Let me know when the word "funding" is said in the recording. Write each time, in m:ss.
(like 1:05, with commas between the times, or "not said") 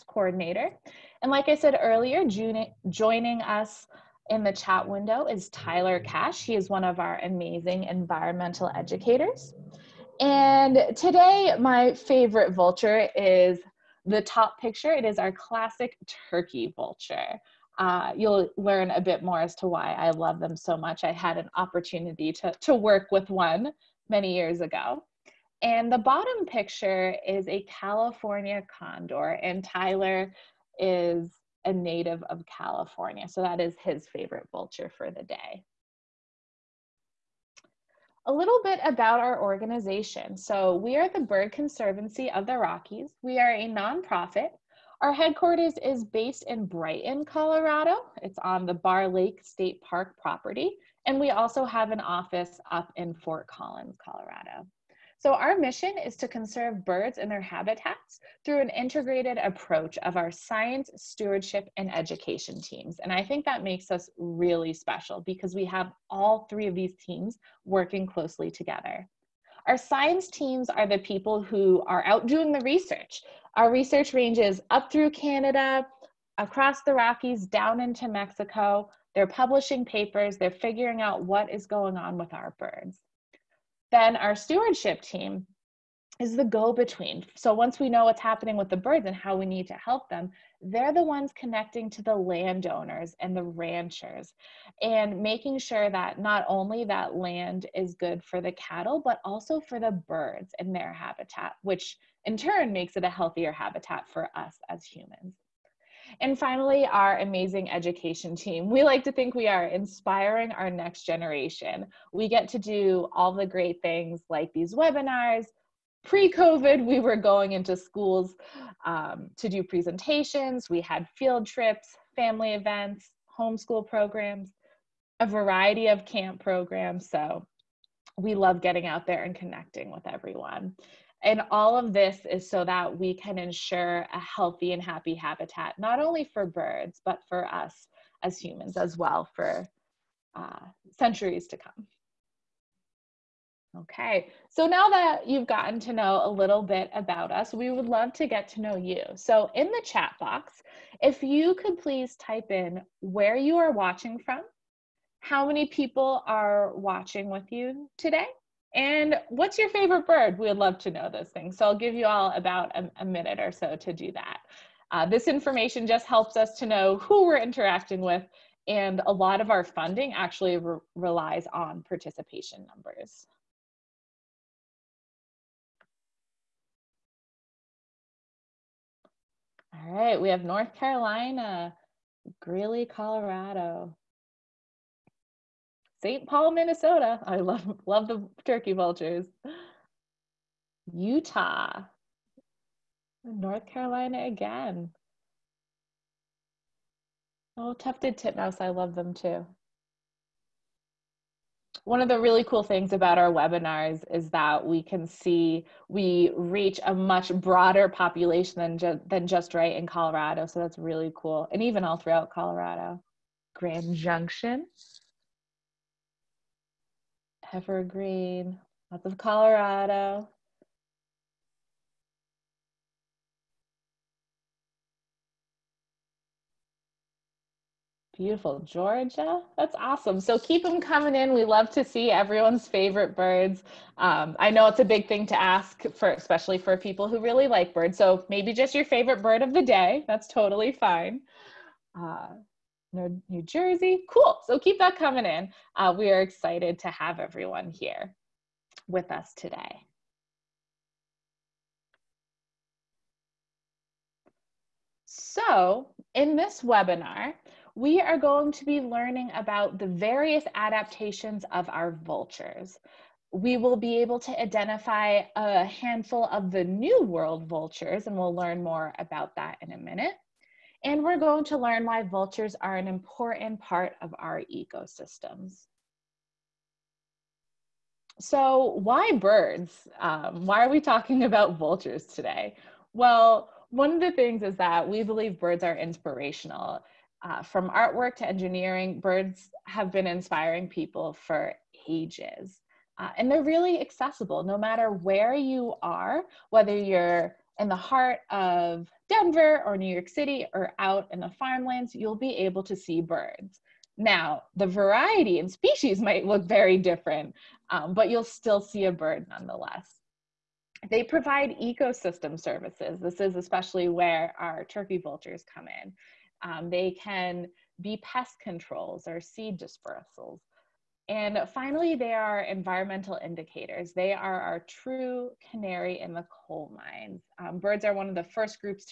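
2:49.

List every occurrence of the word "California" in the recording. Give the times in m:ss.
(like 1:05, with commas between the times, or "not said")
0:27, 0:32.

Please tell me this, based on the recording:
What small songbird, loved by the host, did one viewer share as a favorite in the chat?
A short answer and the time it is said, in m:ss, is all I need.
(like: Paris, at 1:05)
Tufted titmouse, at 3:17.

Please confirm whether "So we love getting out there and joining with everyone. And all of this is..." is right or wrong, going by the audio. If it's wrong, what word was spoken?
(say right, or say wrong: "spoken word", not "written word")
wrong: "connecting", not "joining".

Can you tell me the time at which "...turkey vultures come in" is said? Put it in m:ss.
5:14.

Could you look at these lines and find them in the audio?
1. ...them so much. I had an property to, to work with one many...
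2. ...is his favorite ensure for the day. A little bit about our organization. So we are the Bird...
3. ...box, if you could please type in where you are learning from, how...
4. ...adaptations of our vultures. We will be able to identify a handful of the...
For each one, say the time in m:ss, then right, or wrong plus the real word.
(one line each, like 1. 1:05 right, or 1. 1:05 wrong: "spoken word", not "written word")
1. 0:20 wrong: "opportunity", not "property"
2. 0:33 wrong: "vulture", not "ensure"
3. 2:30 wrong: "watching", not "learning"
4. 4:20 right.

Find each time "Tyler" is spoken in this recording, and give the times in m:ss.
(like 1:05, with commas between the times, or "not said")
0:05, 0:29.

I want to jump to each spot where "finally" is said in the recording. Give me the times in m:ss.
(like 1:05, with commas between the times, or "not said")
1:46, 5:21.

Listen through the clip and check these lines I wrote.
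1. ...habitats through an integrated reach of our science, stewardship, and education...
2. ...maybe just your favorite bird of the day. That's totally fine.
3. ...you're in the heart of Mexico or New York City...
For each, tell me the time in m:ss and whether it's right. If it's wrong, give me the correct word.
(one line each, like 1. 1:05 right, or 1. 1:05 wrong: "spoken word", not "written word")
1. 0:57 wrong: "approach", not "reach"
2. 3:58 right
3. 4:56 wrong: "Denver", not "Mexico".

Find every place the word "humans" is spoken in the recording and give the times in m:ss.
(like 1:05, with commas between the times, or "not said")
1:44, 2:18.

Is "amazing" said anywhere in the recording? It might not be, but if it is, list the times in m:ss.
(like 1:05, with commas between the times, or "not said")
0:07, 1:47.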